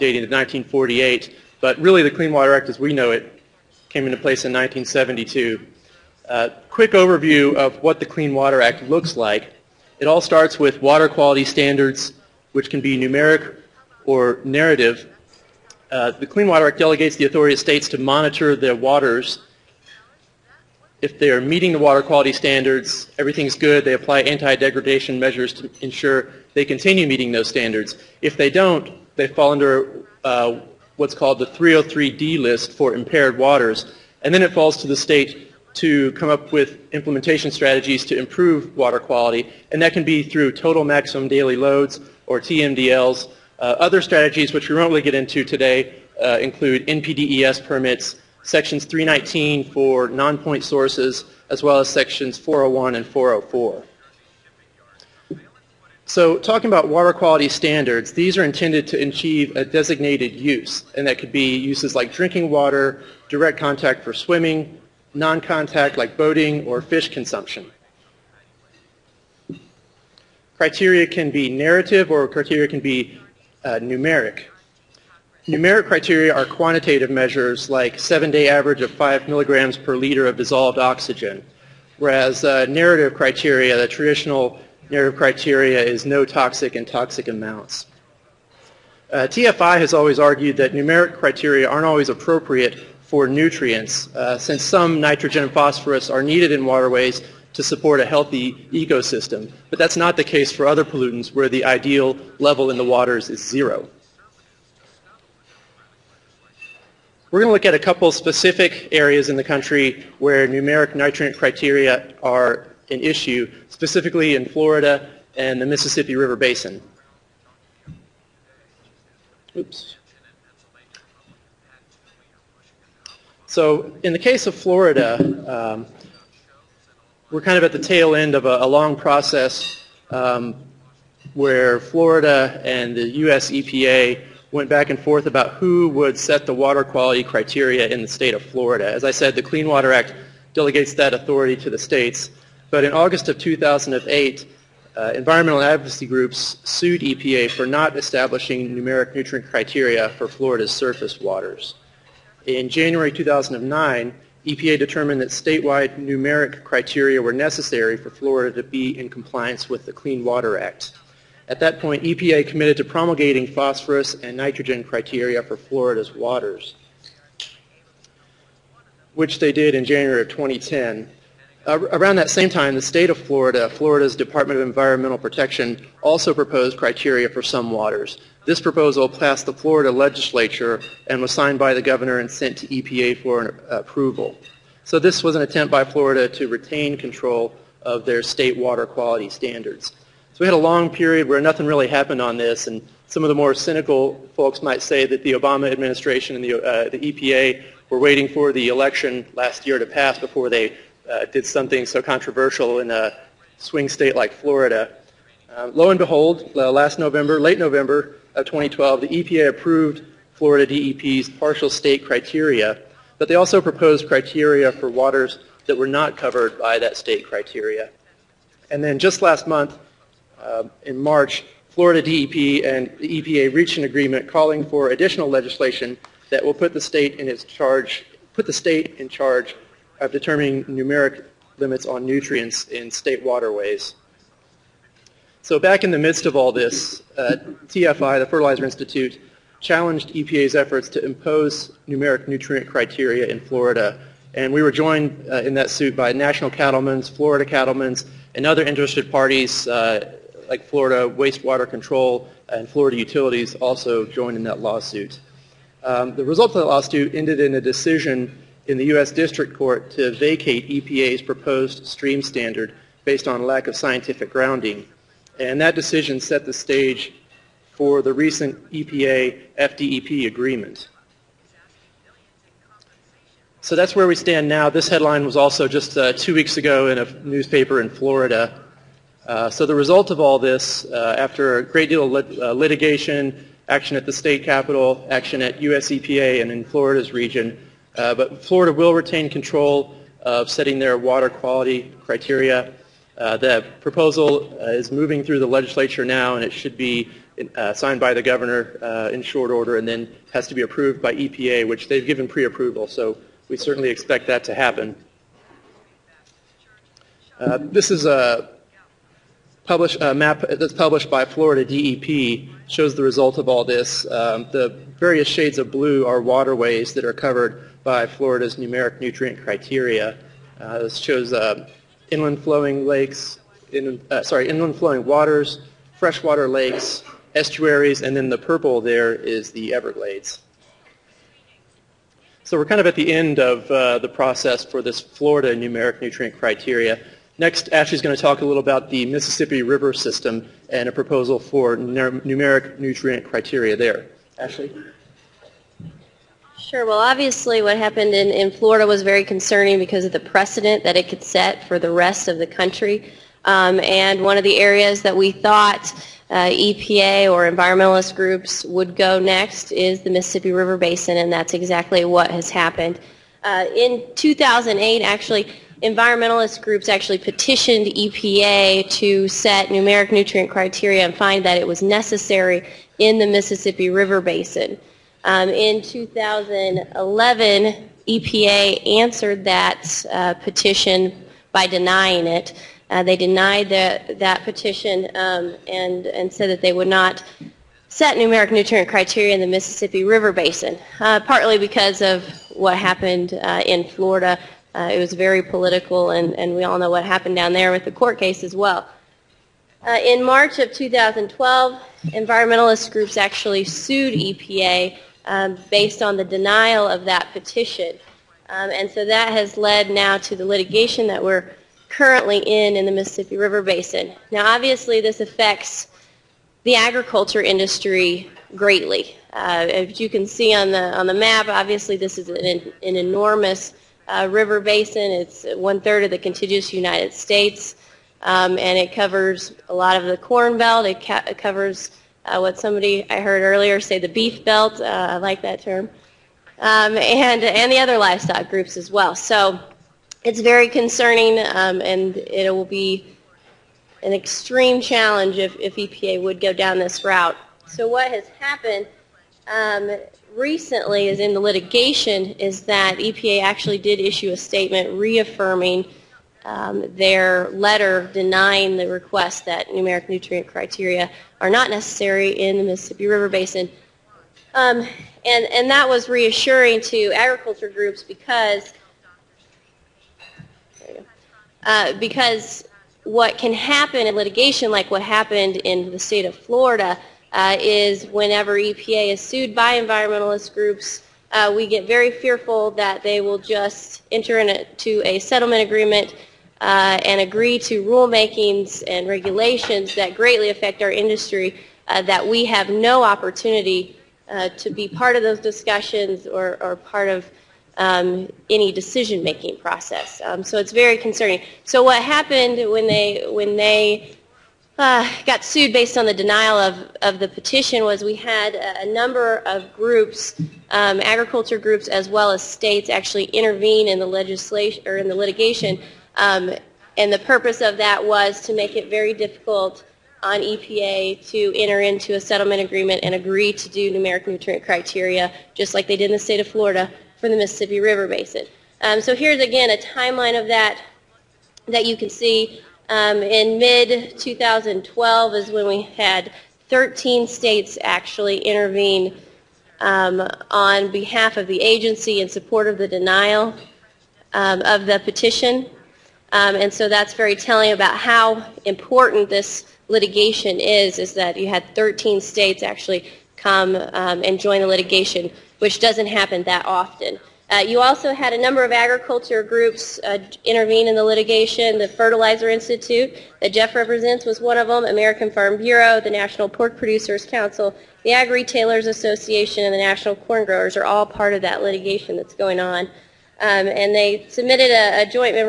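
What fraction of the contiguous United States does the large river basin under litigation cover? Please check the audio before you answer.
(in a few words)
One-third.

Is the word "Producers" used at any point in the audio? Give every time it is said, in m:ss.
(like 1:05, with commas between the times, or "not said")
9:26.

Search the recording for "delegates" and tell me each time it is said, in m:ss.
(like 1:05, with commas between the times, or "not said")
0:16, 2:20.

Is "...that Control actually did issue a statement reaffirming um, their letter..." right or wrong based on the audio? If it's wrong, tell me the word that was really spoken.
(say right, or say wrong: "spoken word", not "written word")
wrong: "EPA", not "Control".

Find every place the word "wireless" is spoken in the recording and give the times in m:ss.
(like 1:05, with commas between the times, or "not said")
not said.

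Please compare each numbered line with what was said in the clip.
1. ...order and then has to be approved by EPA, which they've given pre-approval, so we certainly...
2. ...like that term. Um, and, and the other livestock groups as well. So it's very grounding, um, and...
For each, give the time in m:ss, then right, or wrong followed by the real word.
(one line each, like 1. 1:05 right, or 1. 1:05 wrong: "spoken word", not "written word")
1. 4:59 right
2. 7:15 wrong: "concerning", not "grounding".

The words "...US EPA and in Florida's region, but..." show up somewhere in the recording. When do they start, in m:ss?
4:45.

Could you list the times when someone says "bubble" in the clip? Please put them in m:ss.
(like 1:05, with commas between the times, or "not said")
not said.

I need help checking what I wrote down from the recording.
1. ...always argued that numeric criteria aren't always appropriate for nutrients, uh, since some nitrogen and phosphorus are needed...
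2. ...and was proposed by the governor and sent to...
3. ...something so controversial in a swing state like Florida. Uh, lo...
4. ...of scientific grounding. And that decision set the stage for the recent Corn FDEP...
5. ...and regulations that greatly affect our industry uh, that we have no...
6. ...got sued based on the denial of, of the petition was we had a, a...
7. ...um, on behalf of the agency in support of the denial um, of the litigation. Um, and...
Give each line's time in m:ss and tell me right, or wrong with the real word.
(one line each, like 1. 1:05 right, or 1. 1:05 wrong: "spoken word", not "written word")
1. 1:29 right
2. 3:01 wrong: "signed", not "proposed"
3. 3:21 right
4. 4:23 wrong: "EPA", not "Corn"
5. 8:08 right
6. 8:25 right
7. 8:59 wrong: "petition", not "litigation".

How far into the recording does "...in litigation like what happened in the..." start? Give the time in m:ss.
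7:54.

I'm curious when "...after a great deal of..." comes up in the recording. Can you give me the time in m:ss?
4:41.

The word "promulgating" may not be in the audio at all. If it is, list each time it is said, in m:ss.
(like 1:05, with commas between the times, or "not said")
2:42.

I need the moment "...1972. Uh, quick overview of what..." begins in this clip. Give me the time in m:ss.
0:04.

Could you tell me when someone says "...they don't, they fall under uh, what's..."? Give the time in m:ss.
0:28.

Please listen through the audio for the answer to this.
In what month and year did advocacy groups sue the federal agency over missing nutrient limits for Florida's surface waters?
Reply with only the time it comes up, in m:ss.
2:22.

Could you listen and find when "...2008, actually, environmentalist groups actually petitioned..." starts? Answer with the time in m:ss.
6:04.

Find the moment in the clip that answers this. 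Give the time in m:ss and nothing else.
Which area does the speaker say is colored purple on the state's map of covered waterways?
5:29.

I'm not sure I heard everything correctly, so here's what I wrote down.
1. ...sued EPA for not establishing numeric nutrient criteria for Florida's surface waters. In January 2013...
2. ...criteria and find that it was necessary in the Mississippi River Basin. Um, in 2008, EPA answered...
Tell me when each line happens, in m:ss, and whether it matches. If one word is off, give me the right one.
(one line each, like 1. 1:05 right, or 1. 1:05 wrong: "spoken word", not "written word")
1. 2:26 wrong: "2009", not "2013"
2. 6:10 wrong: "2011", not "2008".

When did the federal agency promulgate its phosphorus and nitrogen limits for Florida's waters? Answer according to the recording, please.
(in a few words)
January 2010.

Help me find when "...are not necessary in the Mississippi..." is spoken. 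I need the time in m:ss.
7:41.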